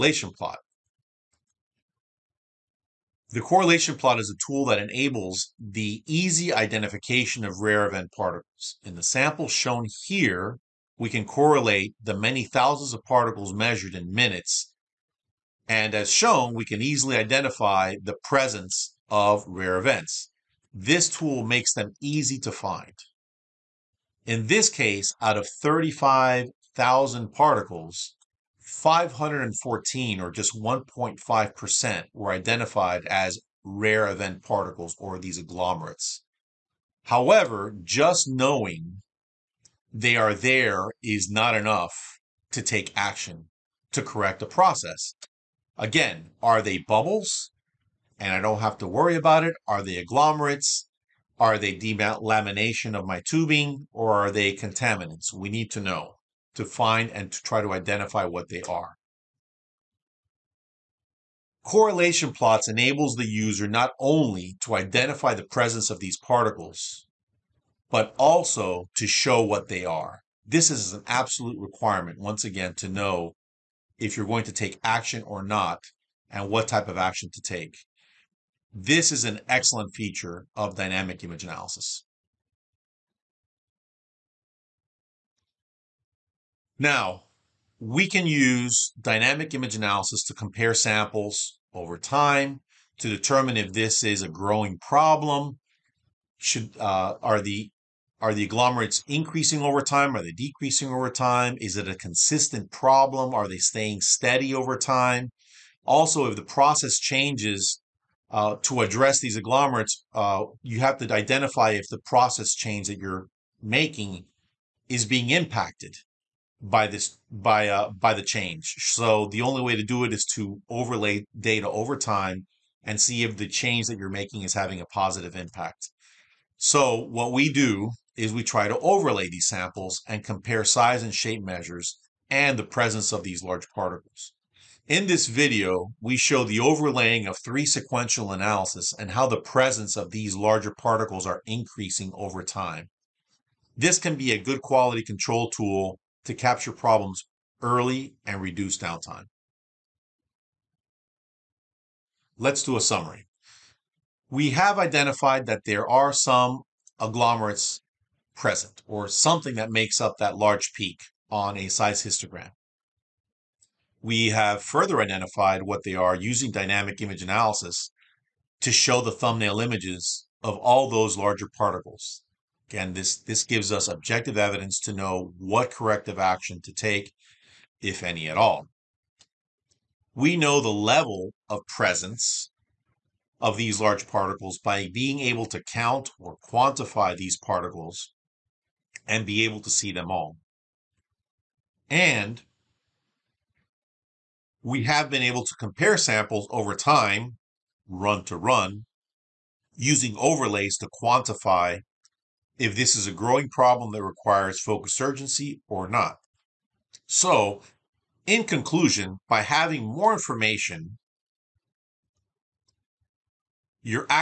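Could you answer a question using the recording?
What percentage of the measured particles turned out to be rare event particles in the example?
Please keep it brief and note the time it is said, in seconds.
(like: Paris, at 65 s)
1.5%, at 30 s.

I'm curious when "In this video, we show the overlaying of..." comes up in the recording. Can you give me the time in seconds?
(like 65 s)
134 s.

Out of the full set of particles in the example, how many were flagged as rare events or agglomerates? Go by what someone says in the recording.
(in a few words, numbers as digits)
514.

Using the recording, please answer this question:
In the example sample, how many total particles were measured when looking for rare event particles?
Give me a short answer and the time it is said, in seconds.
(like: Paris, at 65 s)
35,000, at 25 s.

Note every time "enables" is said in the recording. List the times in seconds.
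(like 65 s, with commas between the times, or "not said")
4 s, 62 s.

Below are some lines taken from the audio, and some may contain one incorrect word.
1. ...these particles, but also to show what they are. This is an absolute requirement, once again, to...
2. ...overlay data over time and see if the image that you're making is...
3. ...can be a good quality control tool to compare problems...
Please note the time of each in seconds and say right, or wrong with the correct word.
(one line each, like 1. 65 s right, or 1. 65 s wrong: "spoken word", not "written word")
1. 65 s right
2. 120 s wrong: "change", not "image"
3. 143 s wrong: "capture", not "compare".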